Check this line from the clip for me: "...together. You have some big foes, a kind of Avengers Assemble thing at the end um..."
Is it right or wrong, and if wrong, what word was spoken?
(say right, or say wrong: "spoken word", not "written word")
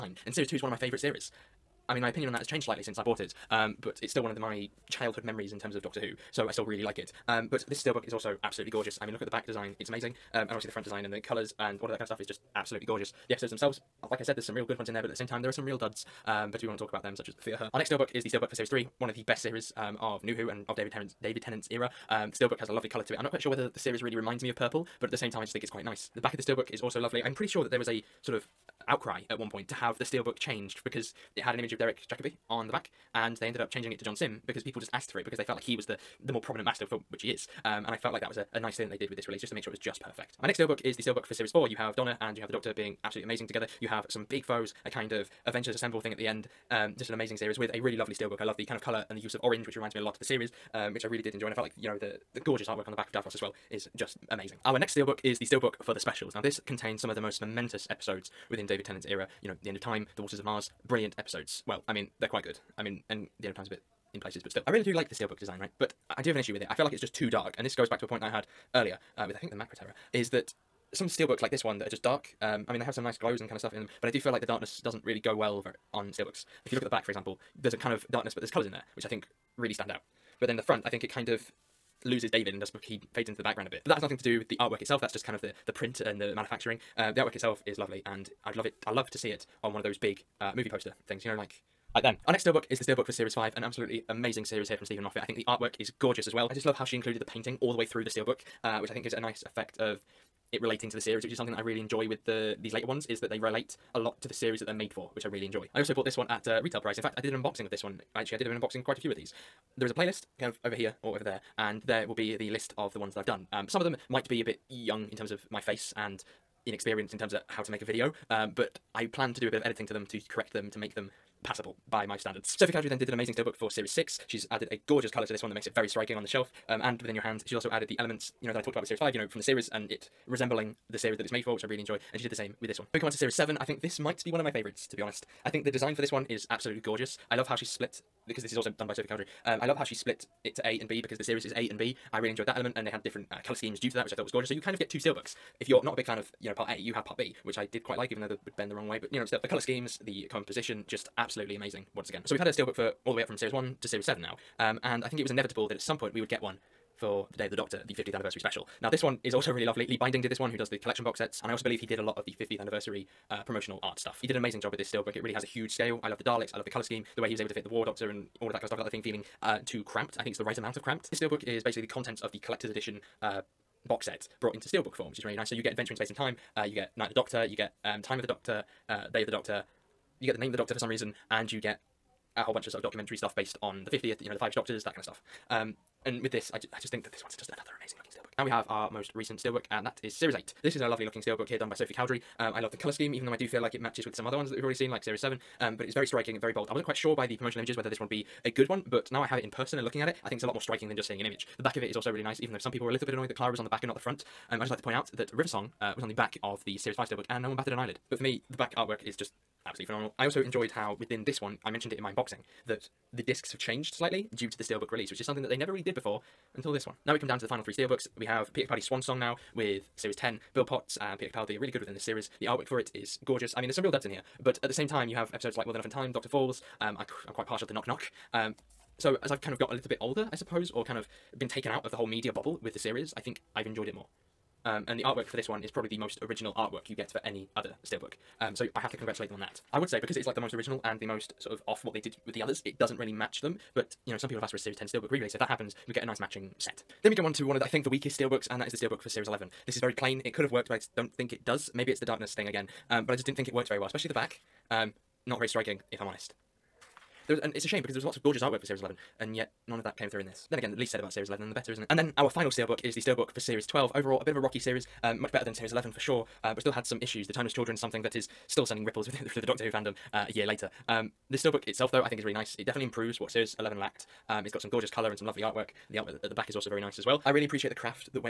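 right.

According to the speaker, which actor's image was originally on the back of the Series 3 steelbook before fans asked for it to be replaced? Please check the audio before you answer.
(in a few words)
Derek Jacobi.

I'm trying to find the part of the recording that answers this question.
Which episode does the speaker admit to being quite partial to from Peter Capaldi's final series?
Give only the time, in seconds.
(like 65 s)
227 s.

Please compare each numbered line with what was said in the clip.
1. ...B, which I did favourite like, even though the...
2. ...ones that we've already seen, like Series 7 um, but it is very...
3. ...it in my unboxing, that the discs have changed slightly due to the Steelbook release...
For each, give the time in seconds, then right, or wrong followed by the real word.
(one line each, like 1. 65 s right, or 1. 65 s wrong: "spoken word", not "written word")
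1. 147 s wrong: "quite", not "favourite"
2. 194 s right
3. 211 s right.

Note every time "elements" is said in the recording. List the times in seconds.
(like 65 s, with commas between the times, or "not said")
127 s, 142 s.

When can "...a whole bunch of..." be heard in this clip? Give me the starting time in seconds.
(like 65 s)
182 s.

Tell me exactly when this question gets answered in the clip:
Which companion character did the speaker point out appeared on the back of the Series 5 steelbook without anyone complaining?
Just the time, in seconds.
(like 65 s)
205 s.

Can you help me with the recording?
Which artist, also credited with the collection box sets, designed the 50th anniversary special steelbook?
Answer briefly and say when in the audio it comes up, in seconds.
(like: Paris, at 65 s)
Lee Binding, at 159 s.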